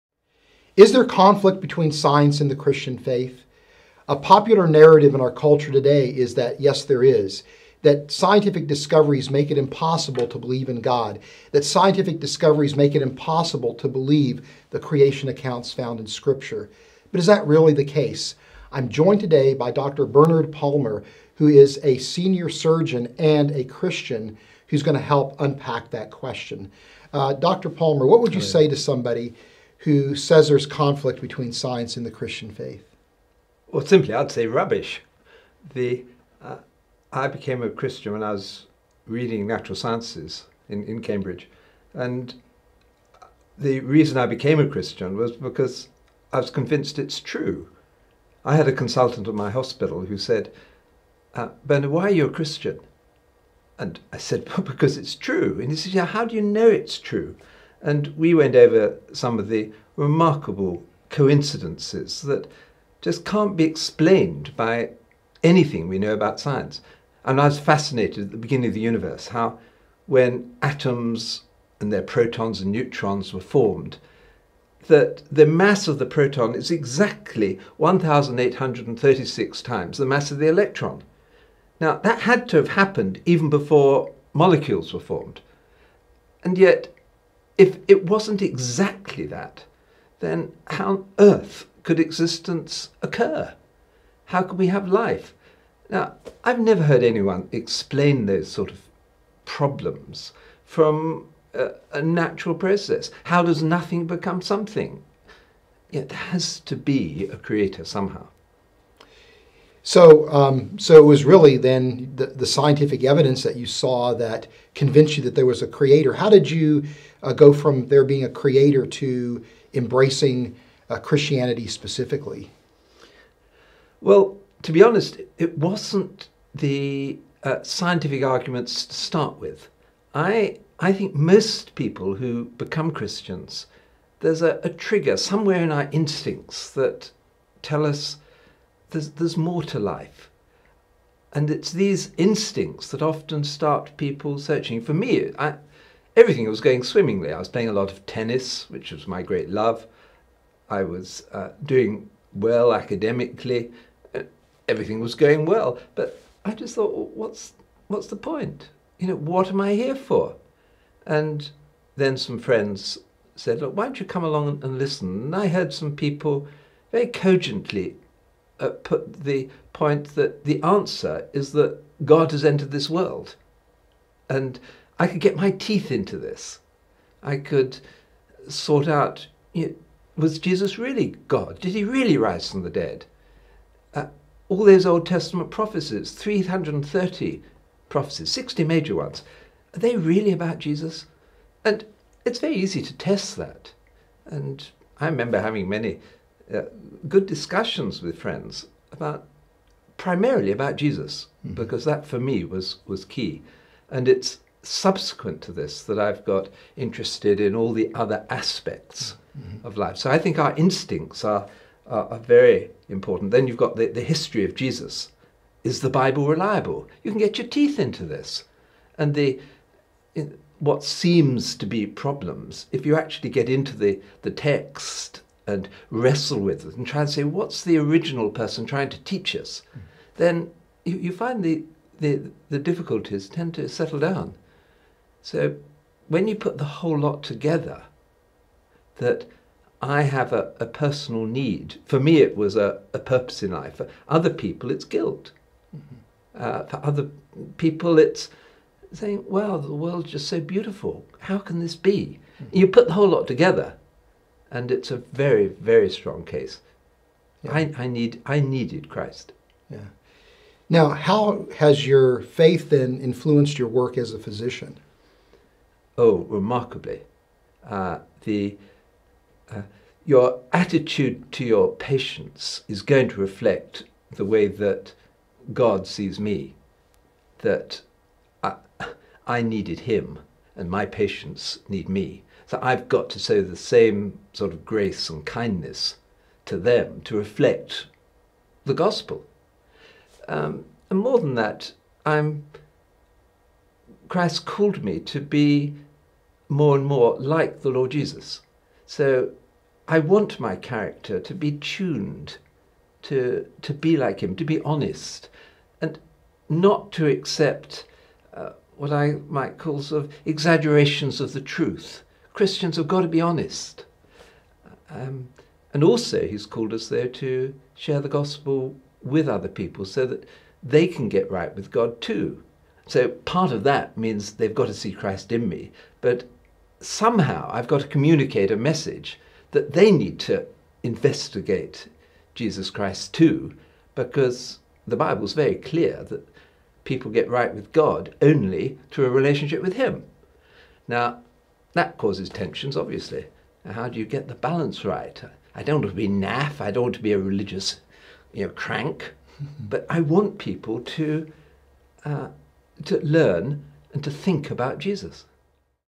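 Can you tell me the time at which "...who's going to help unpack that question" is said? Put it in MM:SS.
00:24.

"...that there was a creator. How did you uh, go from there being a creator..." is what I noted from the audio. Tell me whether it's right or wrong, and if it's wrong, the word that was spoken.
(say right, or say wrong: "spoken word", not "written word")
right.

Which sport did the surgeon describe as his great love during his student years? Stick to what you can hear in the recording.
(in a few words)
Tennis.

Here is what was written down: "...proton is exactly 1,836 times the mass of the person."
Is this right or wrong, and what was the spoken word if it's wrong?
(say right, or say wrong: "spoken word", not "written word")
wrong: "electron", not "person".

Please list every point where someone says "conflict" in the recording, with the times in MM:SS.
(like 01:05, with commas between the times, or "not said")
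00:01, 00:30.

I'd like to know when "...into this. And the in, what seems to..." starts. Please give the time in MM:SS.
03:37.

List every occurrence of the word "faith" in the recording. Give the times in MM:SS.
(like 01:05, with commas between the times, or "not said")
00:02, 00:32, 04:22.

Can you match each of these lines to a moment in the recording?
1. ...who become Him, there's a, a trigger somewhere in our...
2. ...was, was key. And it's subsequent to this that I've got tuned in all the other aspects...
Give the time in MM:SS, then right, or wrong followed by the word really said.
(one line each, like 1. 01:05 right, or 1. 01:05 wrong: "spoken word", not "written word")
1. 02:12 wrong: "Christians", not "Him"
2. 03:22 wrong: "interested", not "tuned".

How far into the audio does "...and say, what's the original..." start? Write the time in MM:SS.
03:47.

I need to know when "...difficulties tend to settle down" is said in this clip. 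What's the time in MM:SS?
03:52.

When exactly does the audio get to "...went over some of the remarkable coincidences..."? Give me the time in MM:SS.
00:58.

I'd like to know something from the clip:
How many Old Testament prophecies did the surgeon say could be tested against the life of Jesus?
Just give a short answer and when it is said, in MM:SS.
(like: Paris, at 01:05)
330, at 03:06.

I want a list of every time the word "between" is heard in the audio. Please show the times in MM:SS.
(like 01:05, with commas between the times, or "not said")
00:01, 00:31.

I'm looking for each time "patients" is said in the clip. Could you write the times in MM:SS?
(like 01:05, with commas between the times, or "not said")
04:31, 04:40.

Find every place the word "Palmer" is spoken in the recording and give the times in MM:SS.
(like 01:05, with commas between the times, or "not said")
00:20, 00:27.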